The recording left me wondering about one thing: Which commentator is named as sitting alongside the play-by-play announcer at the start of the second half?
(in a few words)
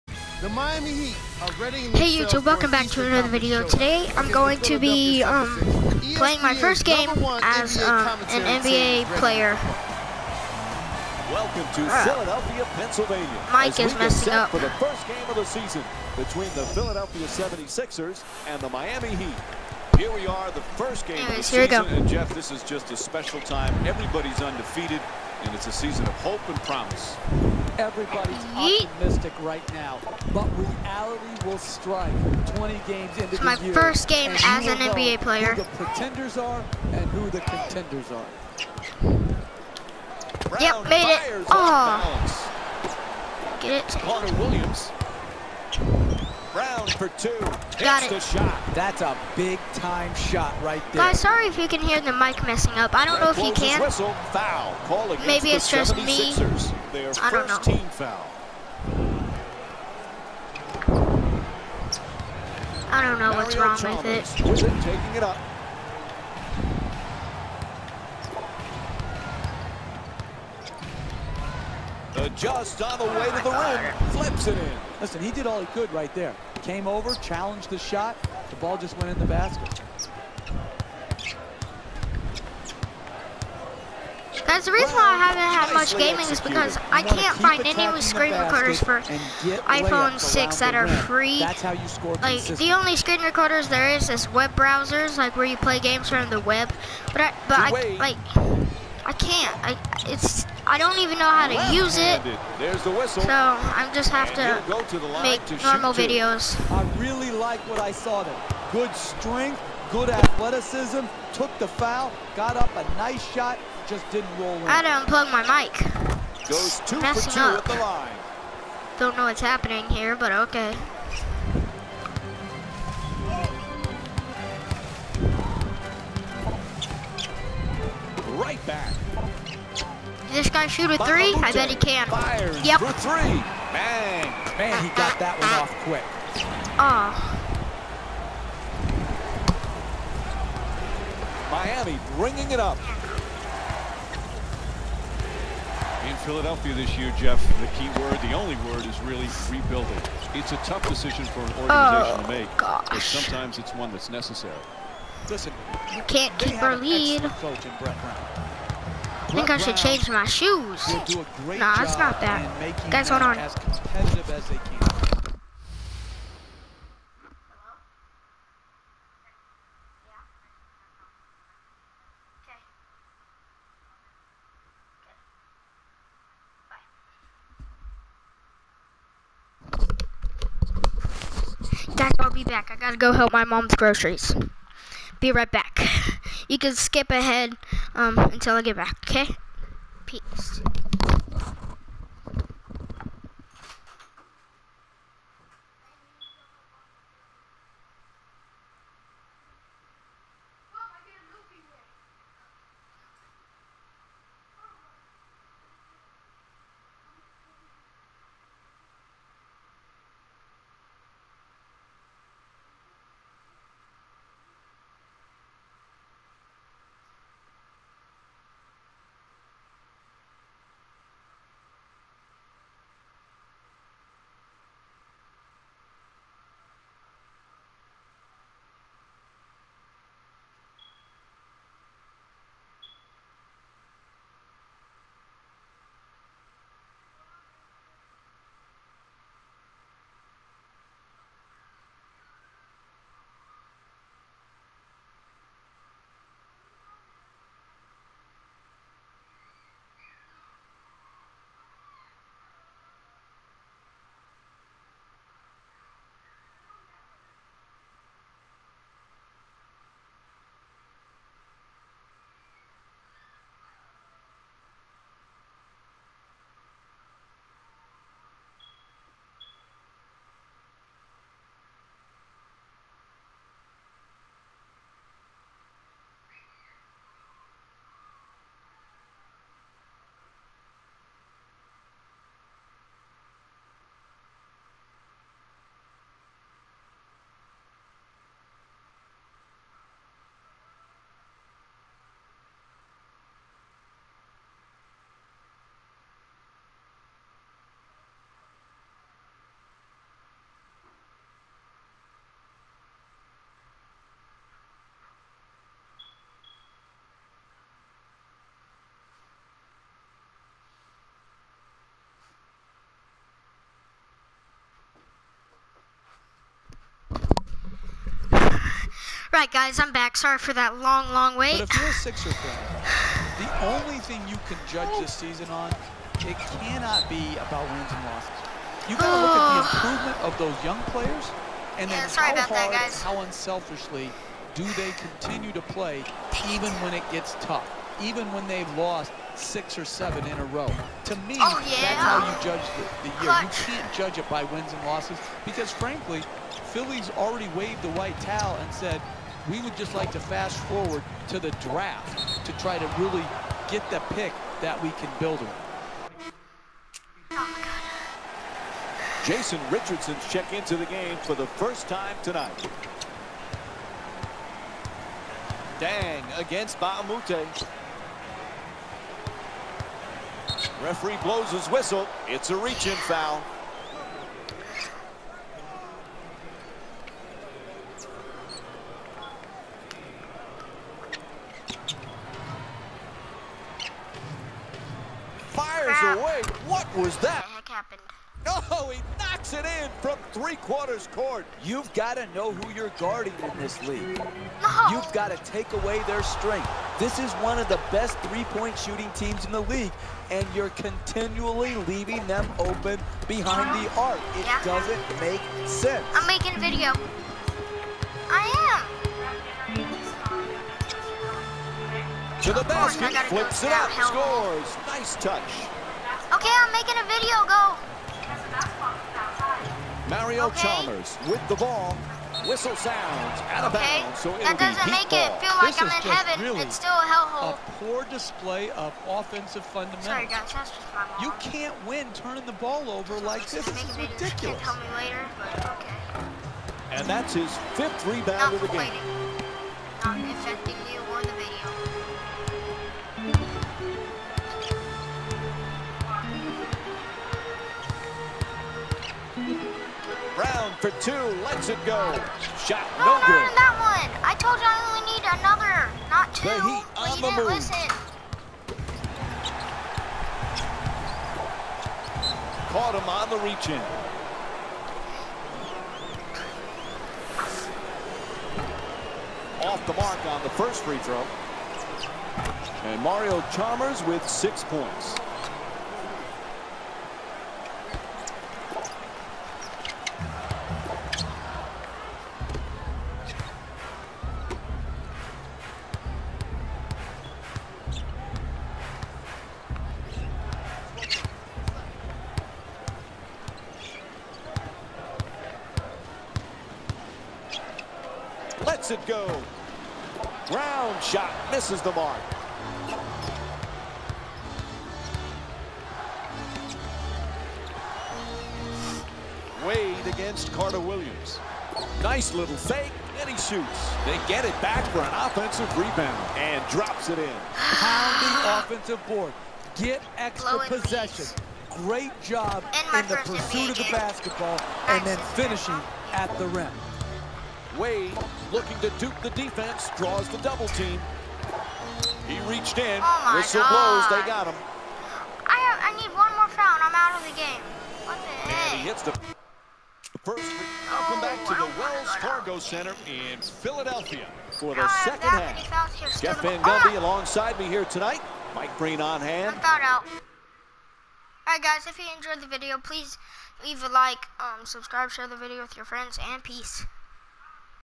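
Jeff Van Gundy.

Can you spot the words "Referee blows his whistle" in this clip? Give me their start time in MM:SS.
06:10.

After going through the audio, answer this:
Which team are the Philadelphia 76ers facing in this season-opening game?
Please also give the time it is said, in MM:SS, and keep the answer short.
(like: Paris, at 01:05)
Miami Heat, at 00:18.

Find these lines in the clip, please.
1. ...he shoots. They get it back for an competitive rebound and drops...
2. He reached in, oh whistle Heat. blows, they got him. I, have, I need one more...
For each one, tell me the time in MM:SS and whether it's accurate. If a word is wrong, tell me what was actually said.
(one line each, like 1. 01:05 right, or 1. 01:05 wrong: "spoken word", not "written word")
1. 08:33 wrong: "offensive", not "competitive"
2. 08:52 wrong: "God", not "Heat".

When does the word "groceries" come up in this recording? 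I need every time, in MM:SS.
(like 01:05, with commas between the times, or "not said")
03:03.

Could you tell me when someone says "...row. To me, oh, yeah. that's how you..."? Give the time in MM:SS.
05:40.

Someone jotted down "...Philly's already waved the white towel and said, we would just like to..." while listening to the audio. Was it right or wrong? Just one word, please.
right.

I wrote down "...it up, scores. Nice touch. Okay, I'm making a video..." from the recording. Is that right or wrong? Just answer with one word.
right.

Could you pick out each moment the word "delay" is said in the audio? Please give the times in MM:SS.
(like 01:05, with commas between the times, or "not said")
not said.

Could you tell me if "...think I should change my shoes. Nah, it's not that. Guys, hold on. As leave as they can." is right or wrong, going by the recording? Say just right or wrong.
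wrong.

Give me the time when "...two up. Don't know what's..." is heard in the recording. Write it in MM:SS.
01:57.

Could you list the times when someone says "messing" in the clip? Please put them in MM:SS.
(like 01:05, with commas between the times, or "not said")
00:13, 00:52, 01:57.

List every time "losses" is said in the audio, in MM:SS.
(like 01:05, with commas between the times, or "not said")
05:28, 05:44.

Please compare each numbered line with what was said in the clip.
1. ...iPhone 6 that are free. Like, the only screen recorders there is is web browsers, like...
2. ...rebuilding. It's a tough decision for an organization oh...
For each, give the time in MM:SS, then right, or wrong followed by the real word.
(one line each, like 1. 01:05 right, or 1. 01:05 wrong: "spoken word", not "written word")
1. 01:29 right
2. 02:29 right.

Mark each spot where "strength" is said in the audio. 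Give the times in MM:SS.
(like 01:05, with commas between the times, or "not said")
01:48, 06:36.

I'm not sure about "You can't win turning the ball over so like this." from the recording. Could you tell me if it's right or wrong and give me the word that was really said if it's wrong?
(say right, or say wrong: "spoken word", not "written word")
right.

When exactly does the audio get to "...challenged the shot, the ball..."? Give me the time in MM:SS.
01:17.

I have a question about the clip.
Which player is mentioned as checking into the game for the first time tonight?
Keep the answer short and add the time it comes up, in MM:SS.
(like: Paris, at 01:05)
Jason Richardson, at 05:59.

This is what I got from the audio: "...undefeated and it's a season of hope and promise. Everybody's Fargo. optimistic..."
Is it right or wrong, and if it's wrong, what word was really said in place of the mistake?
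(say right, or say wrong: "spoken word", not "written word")
wrong: "Yeet", not "Fargo".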